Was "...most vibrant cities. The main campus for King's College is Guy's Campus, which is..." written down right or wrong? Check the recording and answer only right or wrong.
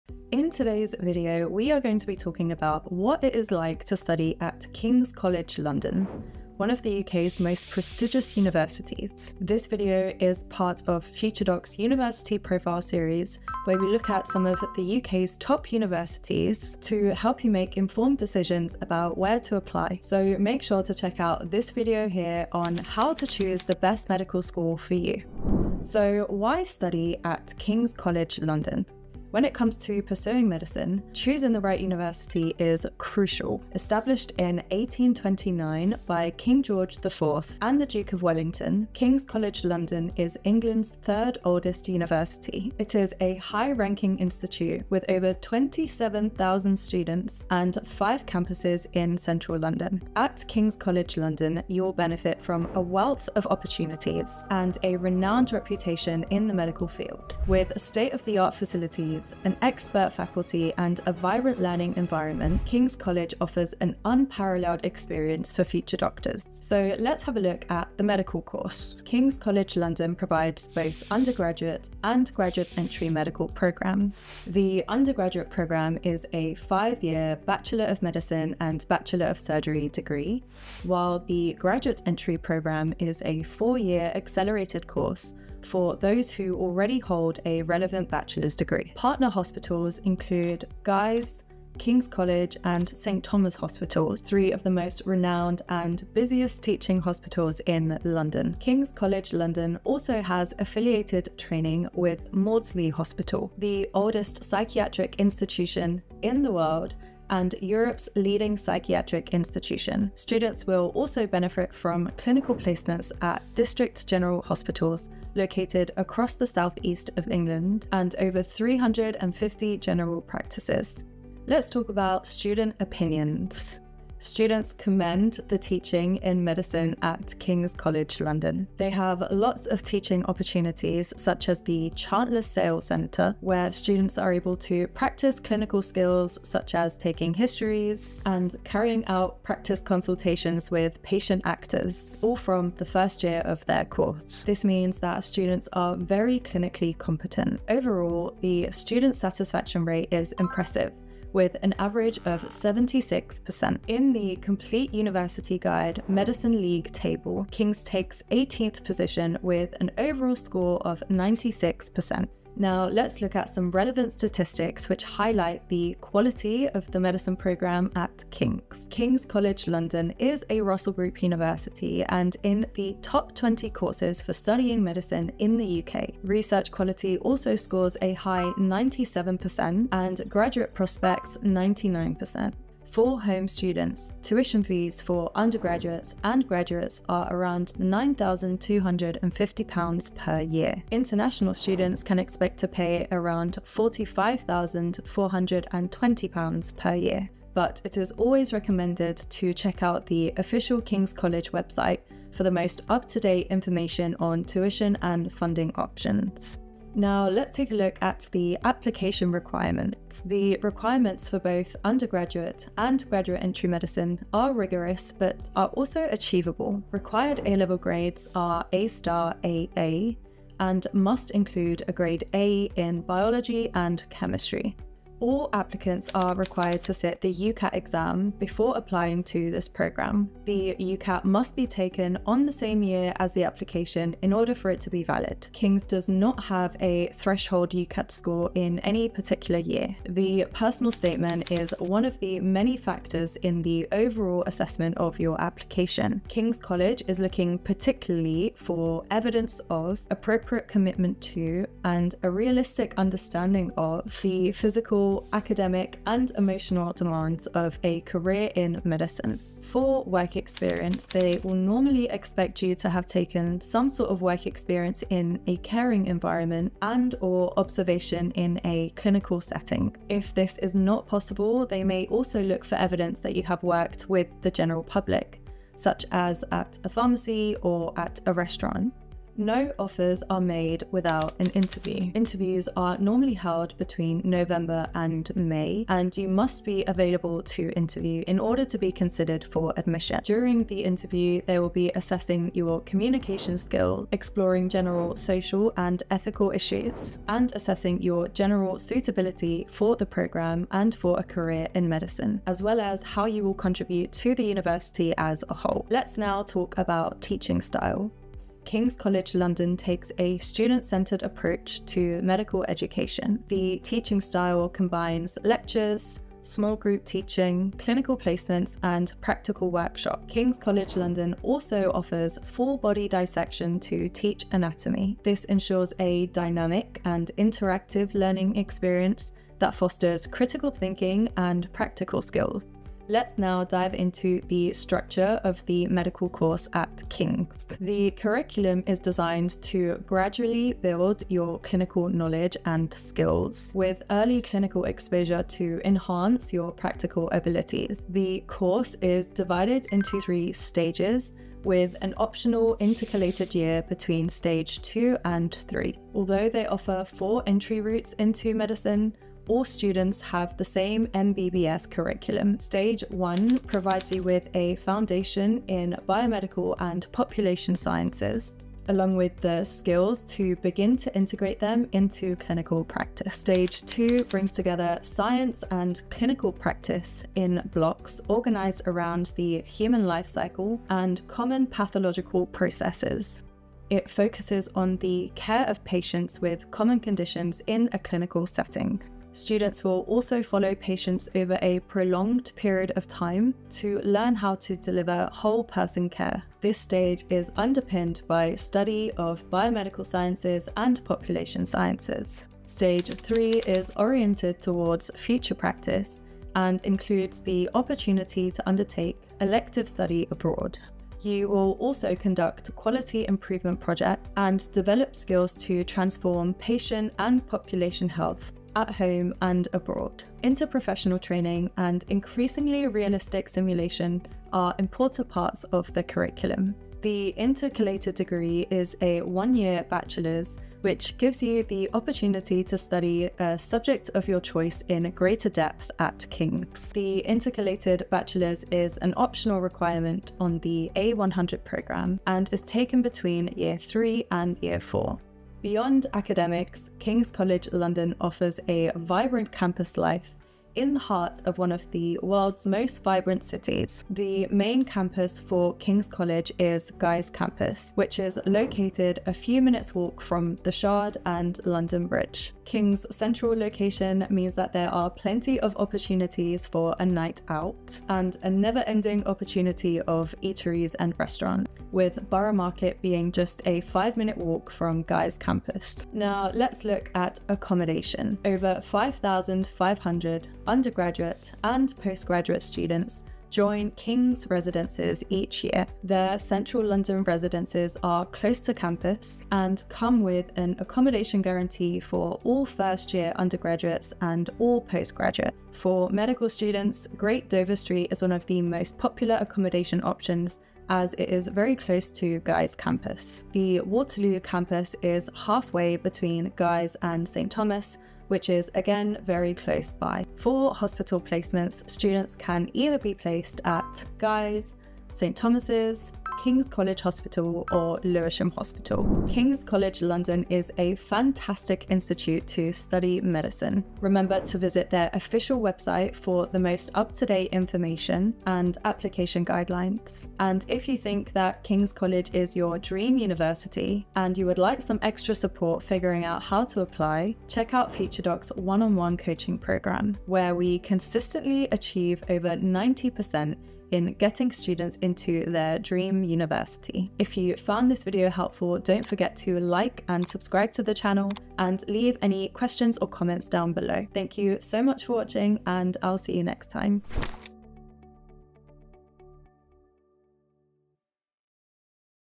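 right.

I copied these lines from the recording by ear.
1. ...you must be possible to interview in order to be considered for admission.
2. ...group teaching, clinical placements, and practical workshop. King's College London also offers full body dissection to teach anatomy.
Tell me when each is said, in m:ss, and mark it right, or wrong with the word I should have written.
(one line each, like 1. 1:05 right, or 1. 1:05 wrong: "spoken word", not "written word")
1. 4:46 wrong: "available", not "possible"
2. 5:16 right.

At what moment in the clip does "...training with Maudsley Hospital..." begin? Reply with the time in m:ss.
1:41.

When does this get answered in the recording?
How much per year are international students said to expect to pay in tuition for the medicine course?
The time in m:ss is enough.
3:13.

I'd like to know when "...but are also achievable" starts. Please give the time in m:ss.
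3:35.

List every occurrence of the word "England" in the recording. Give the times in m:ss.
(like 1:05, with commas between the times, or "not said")
0:40, 1:57.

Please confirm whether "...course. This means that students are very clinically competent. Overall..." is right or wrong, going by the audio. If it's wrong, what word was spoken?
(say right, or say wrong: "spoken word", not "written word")
right.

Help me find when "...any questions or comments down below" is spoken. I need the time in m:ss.
9:12.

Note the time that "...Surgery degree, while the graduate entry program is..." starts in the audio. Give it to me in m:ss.
1:19.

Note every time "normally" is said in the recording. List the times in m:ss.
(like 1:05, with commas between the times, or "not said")
4:21, 4:42.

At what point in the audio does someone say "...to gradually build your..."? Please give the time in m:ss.
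5:39.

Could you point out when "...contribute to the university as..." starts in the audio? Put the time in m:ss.
5:03.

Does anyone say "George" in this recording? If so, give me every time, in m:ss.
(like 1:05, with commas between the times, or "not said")
0:36.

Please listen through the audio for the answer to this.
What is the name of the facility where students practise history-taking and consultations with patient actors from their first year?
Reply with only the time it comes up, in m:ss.
2:11.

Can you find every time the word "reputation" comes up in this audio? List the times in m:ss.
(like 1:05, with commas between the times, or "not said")
0:55.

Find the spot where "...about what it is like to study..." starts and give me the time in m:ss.
0:02.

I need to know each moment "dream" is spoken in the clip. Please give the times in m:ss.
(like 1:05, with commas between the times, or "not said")
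8:52, 9:05.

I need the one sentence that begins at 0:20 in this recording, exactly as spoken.
So make sure to check out this video here on how to choose the best medical school for you.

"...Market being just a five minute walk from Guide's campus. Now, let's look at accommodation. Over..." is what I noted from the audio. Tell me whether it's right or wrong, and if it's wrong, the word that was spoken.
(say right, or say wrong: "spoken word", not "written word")
wrong: "Guy", not "Guide".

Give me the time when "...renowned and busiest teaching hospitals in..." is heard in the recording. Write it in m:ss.
1:35.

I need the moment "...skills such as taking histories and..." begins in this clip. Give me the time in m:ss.
2:15.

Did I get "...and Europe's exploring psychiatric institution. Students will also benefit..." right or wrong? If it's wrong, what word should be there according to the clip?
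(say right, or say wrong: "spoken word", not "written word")
wrong: "leading", not "exploring".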